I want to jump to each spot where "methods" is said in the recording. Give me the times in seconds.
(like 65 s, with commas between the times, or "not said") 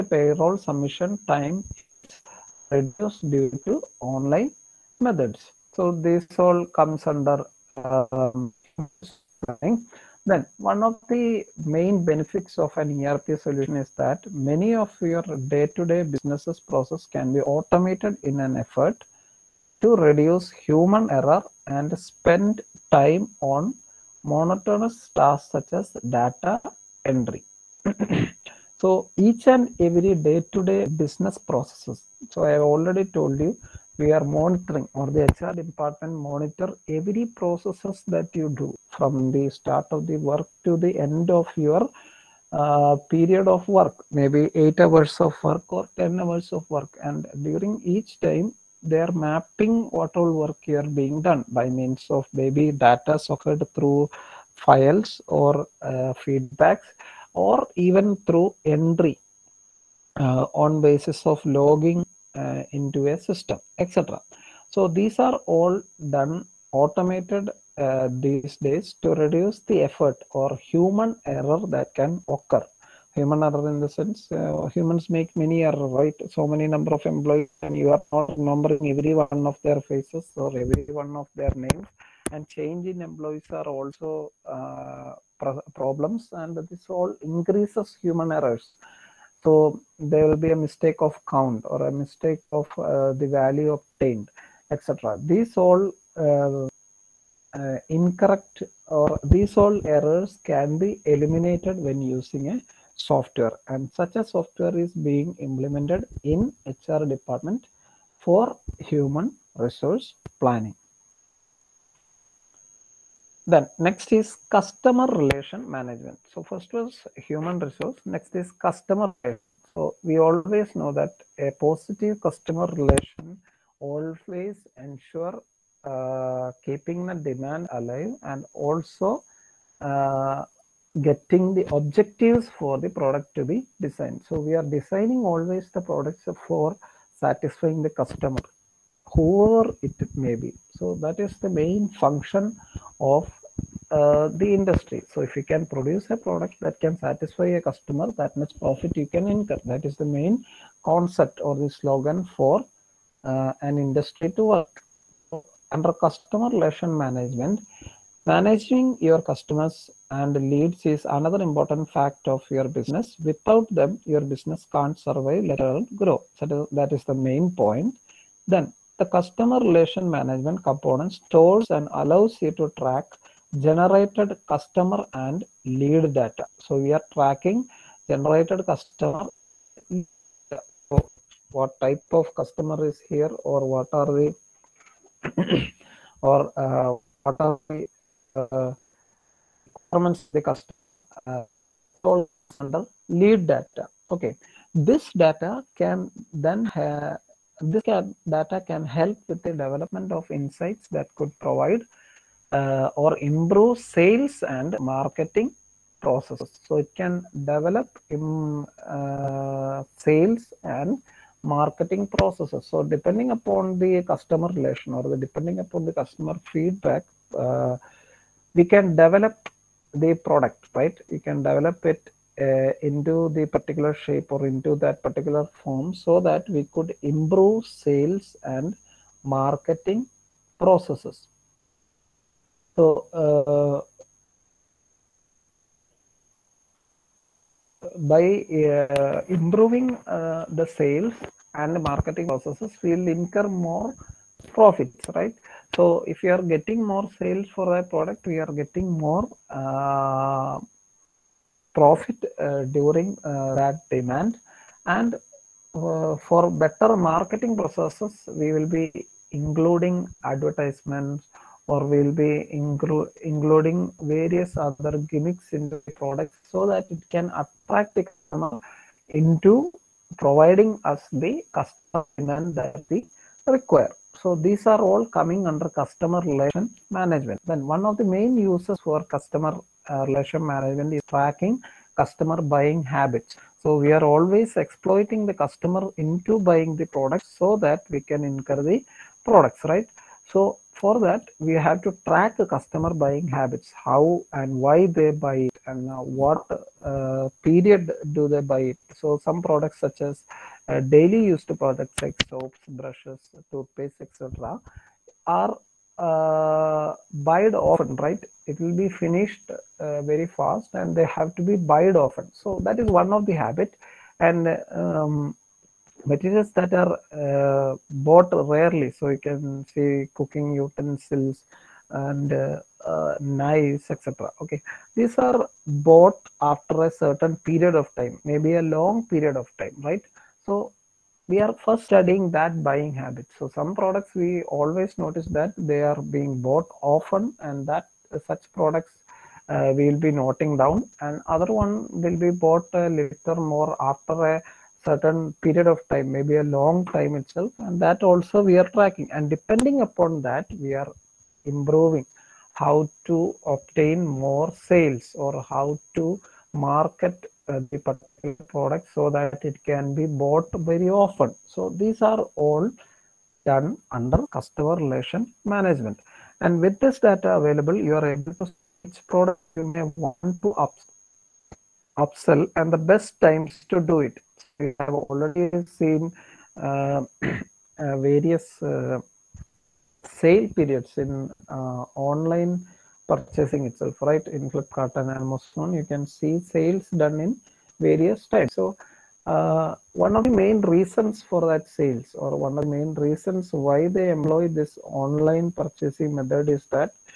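5 s, 396 s.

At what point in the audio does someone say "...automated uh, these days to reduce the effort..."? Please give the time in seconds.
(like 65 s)
66 s.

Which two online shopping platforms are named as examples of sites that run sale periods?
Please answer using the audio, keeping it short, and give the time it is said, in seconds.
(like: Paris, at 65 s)
Flipkart and Amazon, at 384 s.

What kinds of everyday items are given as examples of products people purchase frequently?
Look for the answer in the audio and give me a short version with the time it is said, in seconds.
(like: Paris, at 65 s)
soaps, brushes, toothpaste, at 302 s.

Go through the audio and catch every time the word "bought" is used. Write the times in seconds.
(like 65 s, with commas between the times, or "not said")
317 s, 325 s, 336 s, 342 s, 360 s.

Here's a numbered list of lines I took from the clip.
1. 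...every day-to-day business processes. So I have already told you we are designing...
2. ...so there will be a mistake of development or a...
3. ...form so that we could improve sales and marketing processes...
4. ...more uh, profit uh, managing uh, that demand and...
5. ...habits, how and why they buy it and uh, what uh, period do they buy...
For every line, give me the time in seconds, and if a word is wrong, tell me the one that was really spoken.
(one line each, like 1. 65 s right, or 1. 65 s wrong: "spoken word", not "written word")
1. 29 s wrong: "monitoring", not "designing"
2. 89 s wrong: "count", not "development"
3. 225 s right
4. 249 s wrong: "during", not "managing"
5. 293 s right.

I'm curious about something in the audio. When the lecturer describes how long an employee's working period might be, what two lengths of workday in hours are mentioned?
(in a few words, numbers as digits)
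8 or 10 hours.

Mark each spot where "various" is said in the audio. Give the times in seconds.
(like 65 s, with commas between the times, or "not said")
264 s, 377 s, 387 s.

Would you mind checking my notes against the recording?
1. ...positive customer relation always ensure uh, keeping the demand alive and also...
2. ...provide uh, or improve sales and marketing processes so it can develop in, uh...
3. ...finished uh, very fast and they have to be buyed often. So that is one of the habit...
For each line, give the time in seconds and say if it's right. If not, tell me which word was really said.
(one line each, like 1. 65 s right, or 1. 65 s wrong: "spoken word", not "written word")
1. 121 s right
2. 201 s right
3. 308 s right.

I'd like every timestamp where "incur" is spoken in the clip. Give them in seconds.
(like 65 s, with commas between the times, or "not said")
149 s, 243 s, 288 s.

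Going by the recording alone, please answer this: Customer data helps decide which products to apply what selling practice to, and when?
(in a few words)
upsell.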